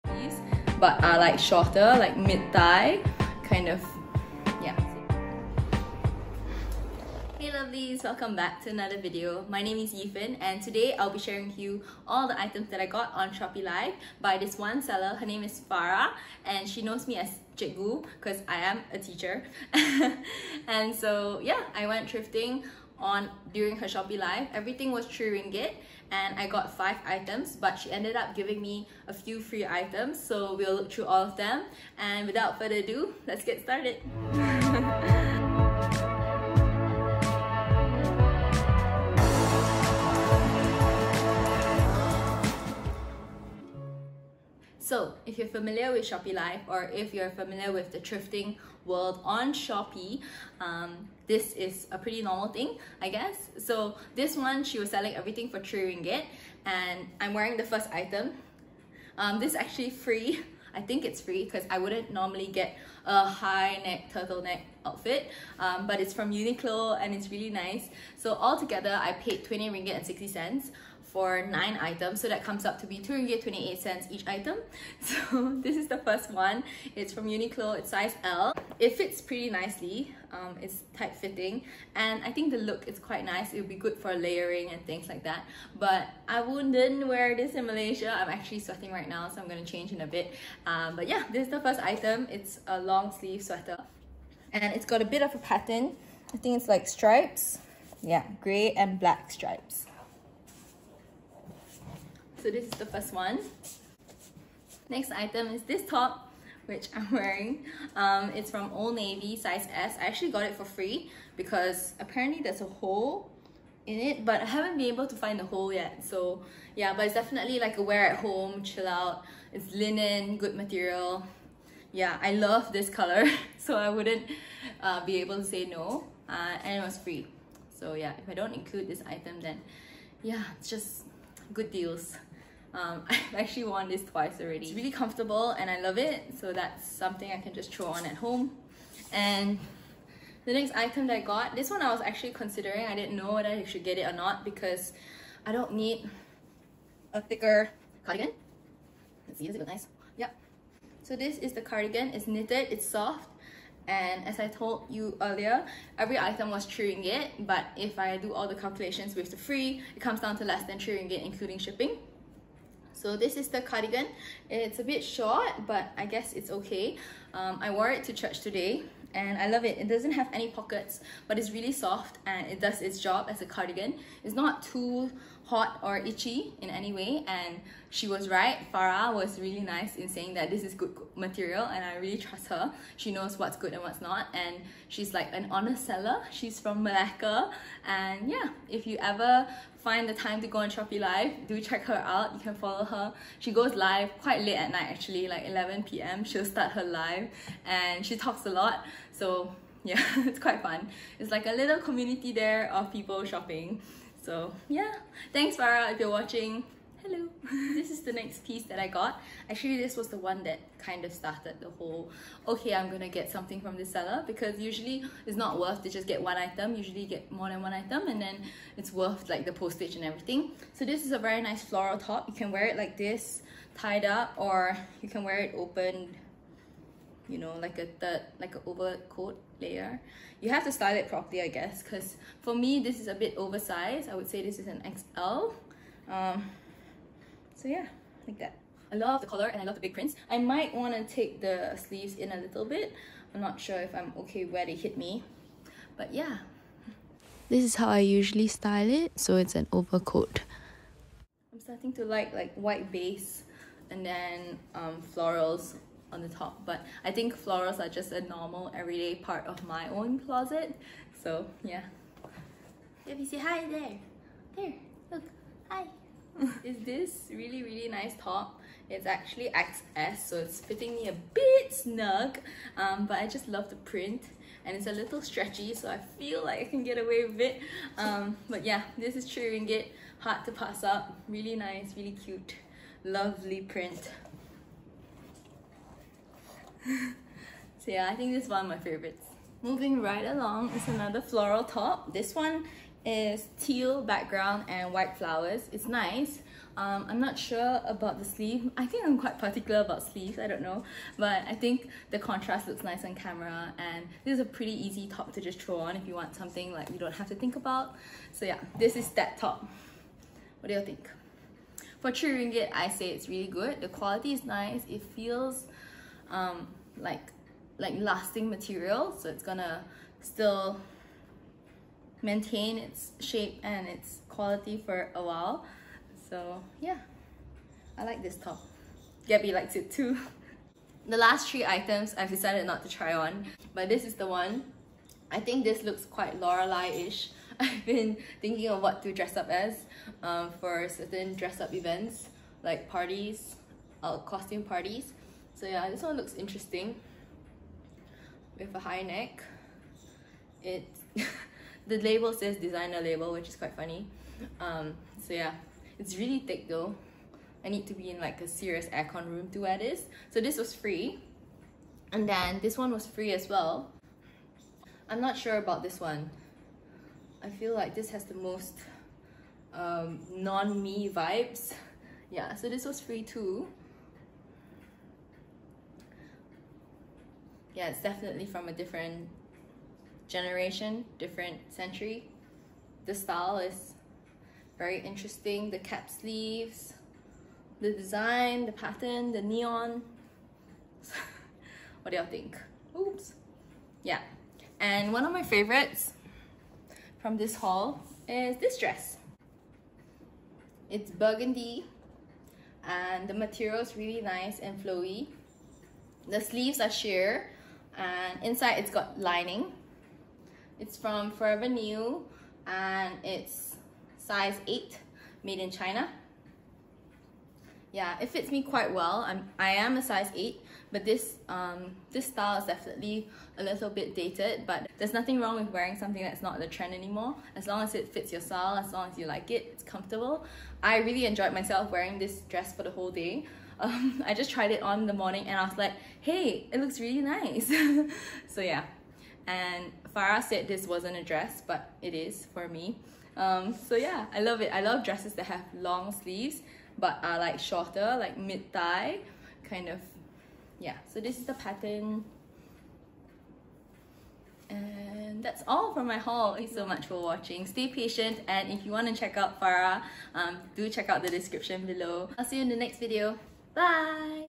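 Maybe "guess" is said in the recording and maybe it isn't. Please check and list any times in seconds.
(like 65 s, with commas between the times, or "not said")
53 s, 166 s, 231 s.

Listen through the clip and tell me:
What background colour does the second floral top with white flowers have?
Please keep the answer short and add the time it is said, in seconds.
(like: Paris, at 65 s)
Teal, at 293 s.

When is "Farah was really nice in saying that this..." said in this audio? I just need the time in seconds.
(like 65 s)
178 s.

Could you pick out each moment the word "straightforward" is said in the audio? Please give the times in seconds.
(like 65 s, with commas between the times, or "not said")
not said.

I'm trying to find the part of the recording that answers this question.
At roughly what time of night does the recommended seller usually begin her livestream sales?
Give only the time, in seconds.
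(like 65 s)
195 s.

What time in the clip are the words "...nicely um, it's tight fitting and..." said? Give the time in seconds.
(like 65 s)
79 s.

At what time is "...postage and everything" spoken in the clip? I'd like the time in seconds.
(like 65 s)
219 s.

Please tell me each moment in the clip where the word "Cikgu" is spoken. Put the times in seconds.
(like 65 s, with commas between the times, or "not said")
17 s.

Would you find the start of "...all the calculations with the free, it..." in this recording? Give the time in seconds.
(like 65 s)
158 s.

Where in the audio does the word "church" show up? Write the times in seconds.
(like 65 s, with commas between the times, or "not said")
168 s.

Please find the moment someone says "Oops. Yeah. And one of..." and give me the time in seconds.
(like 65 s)
392 s.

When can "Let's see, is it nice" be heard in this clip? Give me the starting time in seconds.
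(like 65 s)
149 s.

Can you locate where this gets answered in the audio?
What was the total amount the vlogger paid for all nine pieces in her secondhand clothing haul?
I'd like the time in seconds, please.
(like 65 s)
69 s.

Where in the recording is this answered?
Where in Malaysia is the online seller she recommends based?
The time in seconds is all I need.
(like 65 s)
186 s.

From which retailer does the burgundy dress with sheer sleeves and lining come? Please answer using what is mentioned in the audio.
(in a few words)
Forever New.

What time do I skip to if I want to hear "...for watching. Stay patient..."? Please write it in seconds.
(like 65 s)
457 s.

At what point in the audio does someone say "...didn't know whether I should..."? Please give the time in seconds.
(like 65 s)
142 s.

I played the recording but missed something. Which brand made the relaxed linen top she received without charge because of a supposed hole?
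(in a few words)
Old Navy.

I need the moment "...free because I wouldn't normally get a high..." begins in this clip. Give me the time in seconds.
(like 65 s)
61 s.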